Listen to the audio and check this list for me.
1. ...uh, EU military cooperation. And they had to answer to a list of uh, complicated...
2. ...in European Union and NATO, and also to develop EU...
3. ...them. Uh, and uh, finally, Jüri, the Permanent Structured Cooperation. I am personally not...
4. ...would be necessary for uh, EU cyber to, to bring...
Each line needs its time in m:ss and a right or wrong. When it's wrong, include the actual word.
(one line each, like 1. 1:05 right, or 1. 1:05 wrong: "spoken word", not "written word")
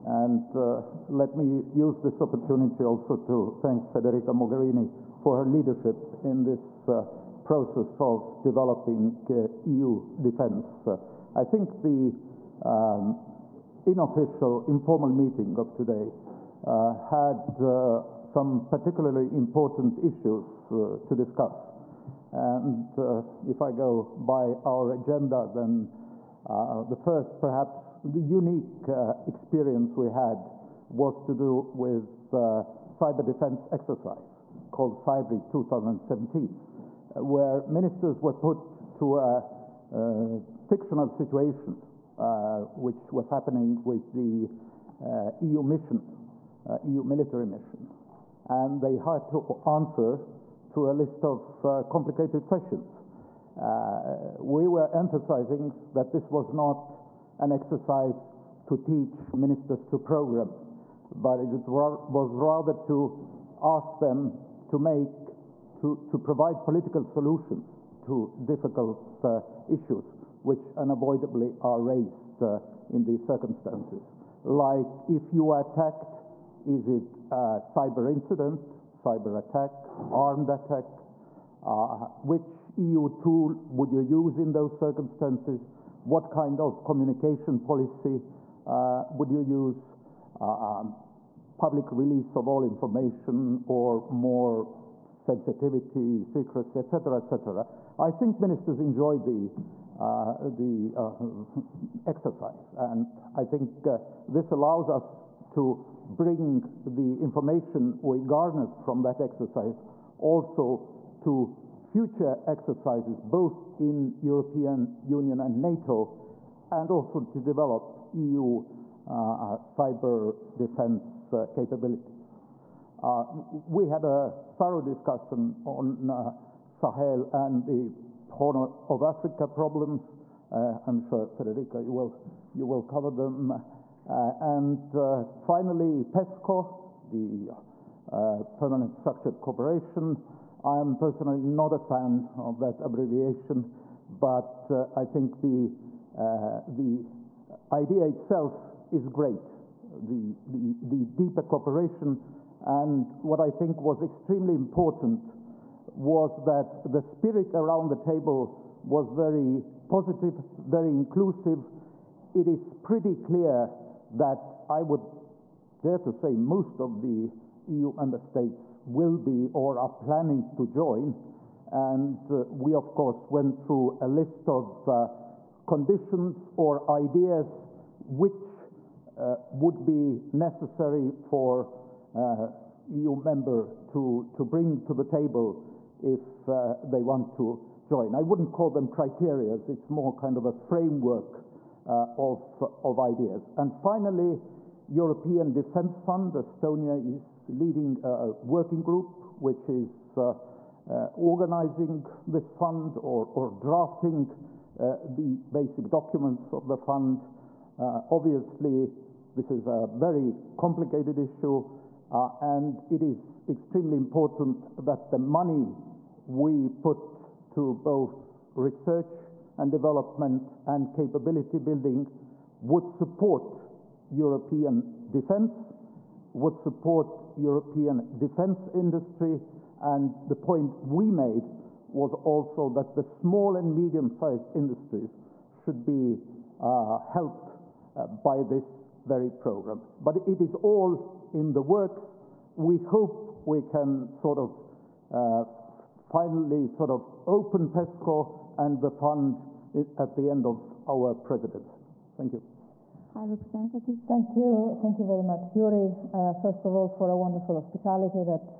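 1. 0:46 wrong: "mission", not "cooperation"
2. 1:53 right
3. 2:13 wrong: "PESCO", not "Jüri"
4. 2:59 wrong: "member", not "cyber".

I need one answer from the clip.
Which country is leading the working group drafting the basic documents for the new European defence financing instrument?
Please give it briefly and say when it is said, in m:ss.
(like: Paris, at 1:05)
Estonia, at 3:16.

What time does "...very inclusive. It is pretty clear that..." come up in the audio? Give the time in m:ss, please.
2:40.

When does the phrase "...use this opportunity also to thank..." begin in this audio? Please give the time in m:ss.
0:01.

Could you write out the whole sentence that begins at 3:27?
obviously, this is a very complicated issue.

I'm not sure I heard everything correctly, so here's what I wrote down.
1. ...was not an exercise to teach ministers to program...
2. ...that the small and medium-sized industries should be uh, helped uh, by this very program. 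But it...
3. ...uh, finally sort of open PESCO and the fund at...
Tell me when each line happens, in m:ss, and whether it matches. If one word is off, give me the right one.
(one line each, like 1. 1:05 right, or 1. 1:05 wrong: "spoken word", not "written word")
1. 0:56 right
2. 3:52 right
3. 4:05 right.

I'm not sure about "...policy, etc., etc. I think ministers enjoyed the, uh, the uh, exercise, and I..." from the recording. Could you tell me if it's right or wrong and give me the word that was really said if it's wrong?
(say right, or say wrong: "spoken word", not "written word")
wrong: "secrecy", not "policy".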